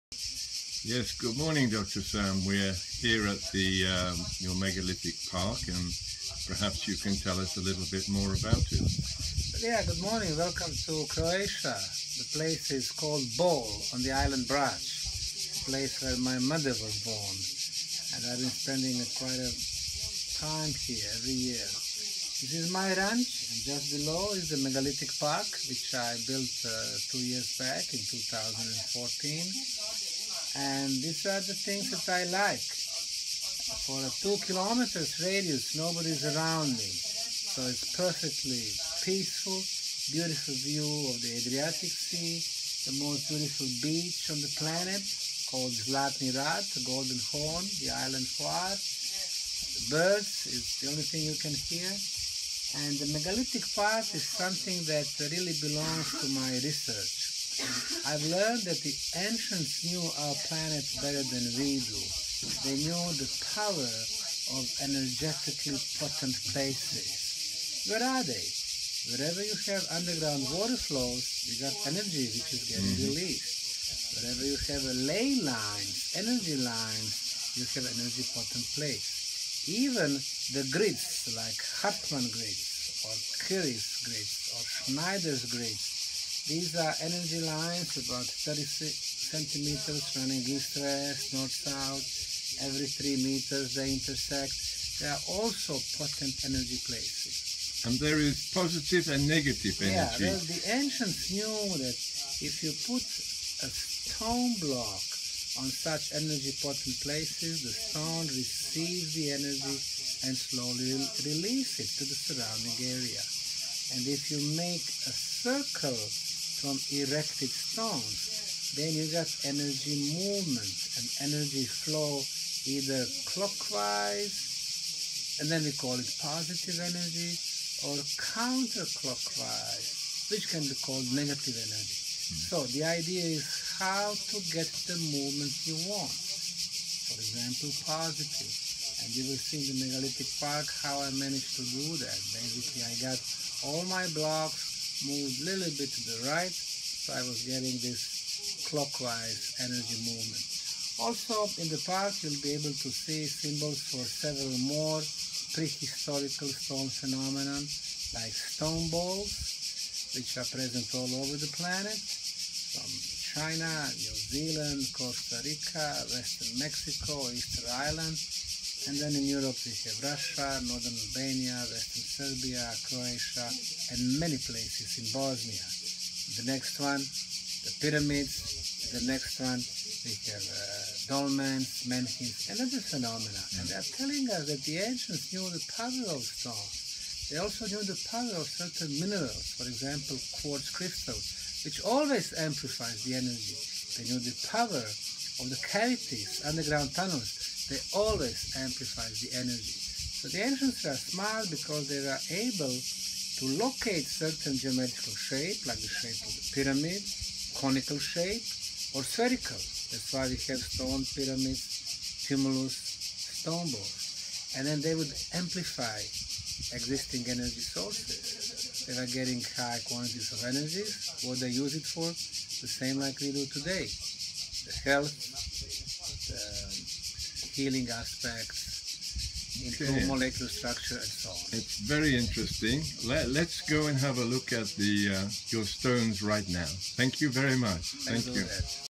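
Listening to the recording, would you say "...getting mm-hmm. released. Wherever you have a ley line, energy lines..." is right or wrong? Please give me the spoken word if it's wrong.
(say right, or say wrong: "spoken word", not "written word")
right.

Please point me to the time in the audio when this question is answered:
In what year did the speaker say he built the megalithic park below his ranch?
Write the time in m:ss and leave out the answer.
0:28.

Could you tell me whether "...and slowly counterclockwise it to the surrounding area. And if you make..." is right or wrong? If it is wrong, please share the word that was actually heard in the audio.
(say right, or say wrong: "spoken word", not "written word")
wrong: "release", not "counterclockwise".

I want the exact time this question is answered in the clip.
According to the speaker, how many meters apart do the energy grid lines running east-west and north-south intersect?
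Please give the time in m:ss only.
1:32.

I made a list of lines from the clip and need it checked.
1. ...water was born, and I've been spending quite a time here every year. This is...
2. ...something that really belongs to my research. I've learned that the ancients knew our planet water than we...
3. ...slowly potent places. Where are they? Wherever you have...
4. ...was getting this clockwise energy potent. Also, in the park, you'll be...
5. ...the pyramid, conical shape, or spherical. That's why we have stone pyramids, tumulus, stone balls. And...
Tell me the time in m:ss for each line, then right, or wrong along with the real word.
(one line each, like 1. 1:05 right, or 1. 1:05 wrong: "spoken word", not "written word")
1. 0:16 wrong: "mother", not "water"
2. 0:54 wrong: "better", not "water"
3. 1:04 wrong: "energetically", not "slowly"
4. 2:27 wrong: "movement", not "potent"
5. 3:26 right.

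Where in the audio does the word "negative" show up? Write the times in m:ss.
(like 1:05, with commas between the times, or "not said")
1:39, 2:11.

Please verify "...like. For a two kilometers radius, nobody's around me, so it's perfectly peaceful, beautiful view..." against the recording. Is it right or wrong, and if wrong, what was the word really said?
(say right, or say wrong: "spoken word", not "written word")
right.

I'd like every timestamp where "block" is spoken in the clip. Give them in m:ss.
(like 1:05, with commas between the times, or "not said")
1:44, 2:24.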